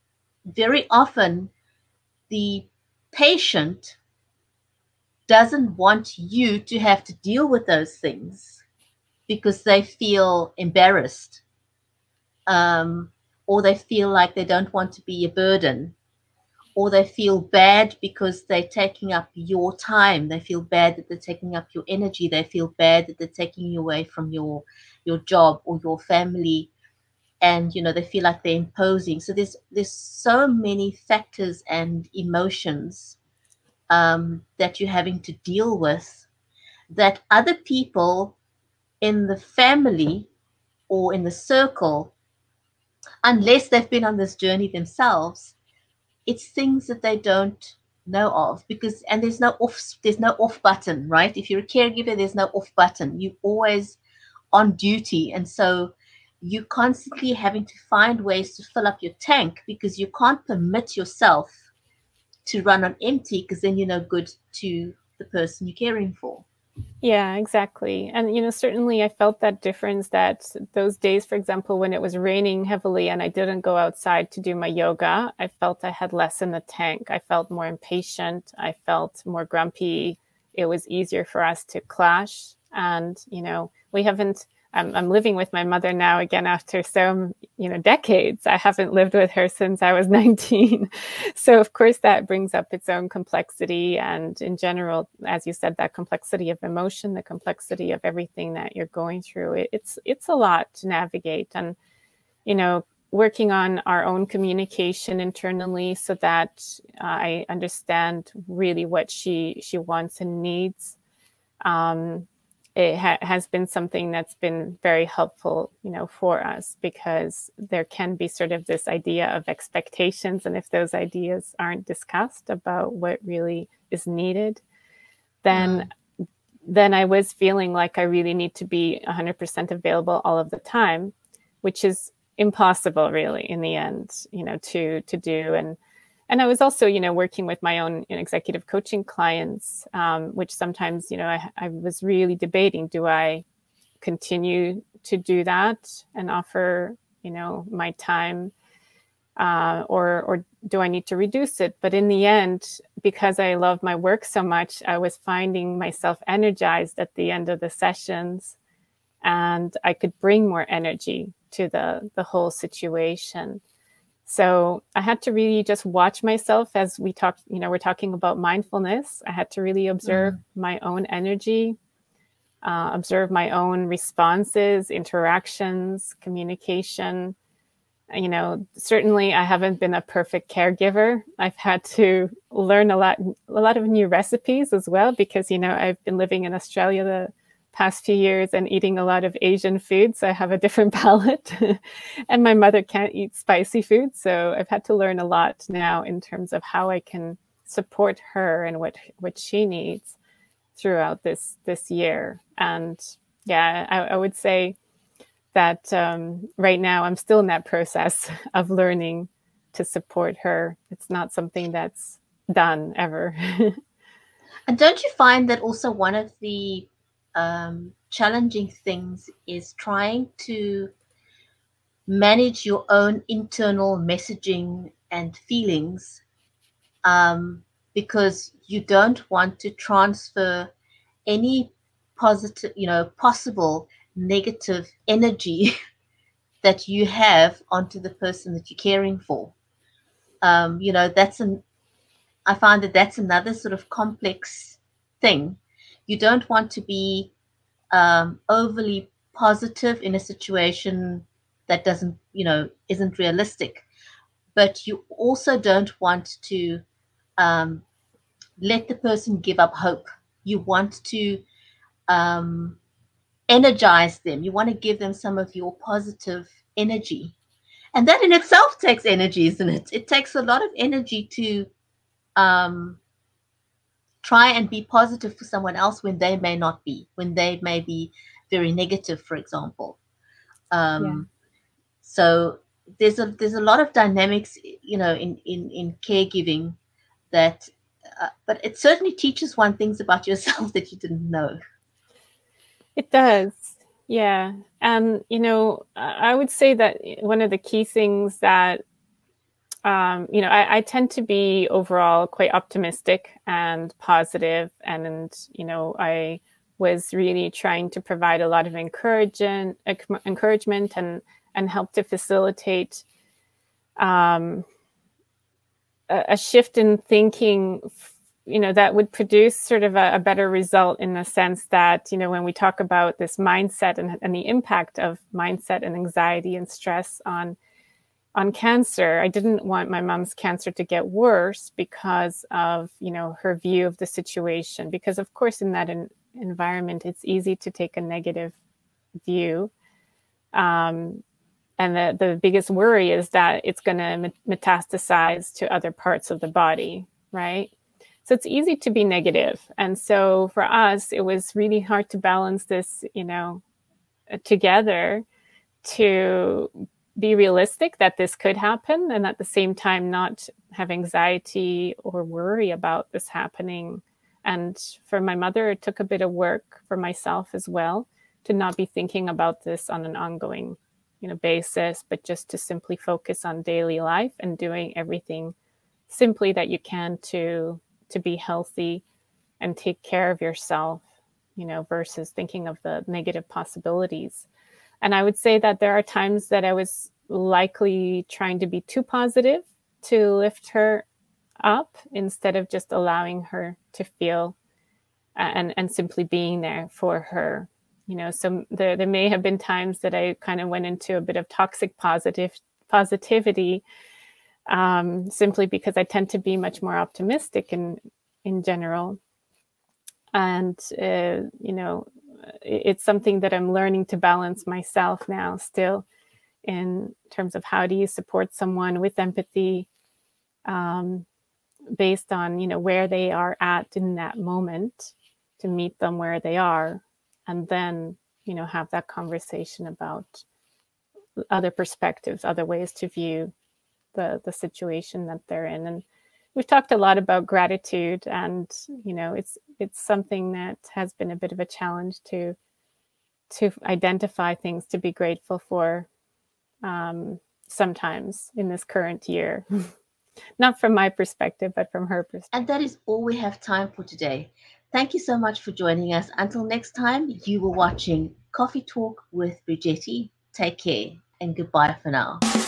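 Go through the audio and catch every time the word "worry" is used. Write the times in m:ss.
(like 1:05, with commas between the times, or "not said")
5:42, 6:02.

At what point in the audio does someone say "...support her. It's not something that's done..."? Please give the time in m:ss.
3:29.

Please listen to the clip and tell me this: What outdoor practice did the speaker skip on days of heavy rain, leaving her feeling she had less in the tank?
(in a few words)
yoga.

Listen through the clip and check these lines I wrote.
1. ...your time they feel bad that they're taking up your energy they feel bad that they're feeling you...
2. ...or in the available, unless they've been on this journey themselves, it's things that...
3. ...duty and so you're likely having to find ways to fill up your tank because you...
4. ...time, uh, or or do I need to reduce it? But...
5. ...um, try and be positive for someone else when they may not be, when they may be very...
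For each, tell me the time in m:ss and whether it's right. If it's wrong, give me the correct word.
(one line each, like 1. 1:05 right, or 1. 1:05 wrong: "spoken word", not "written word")
1. 0:19 wrong: "taking", not "feeling"
2. 0:40 wrong: "circle", not "available"
3. 0:54 wrong: "constantly", not "likely"
4. 2:27 right
5. 4:32 right.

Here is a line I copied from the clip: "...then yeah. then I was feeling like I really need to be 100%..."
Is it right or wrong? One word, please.
right.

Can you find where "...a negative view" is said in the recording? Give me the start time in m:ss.
5:37.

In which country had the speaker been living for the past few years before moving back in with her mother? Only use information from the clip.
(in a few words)
Australia.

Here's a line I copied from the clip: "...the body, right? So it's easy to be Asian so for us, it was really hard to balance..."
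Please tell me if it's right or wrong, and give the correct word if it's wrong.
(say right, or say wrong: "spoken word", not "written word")
wrong: "And", not "Asian".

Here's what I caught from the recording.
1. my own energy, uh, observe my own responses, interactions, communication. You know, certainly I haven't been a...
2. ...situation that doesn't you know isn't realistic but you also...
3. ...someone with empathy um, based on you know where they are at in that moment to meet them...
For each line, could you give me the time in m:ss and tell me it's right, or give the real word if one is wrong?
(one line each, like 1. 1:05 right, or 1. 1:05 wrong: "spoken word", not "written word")
1. 2:50 right
2. 4:10 right
3. 6:58 right.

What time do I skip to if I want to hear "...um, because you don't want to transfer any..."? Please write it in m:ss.
3:47.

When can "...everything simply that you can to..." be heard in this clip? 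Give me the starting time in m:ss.
6:14.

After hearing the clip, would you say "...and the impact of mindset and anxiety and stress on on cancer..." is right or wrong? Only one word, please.
right.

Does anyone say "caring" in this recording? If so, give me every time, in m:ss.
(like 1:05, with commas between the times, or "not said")
1:05, 3:58.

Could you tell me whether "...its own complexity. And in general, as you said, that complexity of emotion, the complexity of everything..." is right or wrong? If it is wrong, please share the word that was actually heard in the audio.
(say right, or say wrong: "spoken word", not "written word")
right.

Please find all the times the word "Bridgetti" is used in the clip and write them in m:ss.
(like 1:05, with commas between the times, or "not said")
7:39.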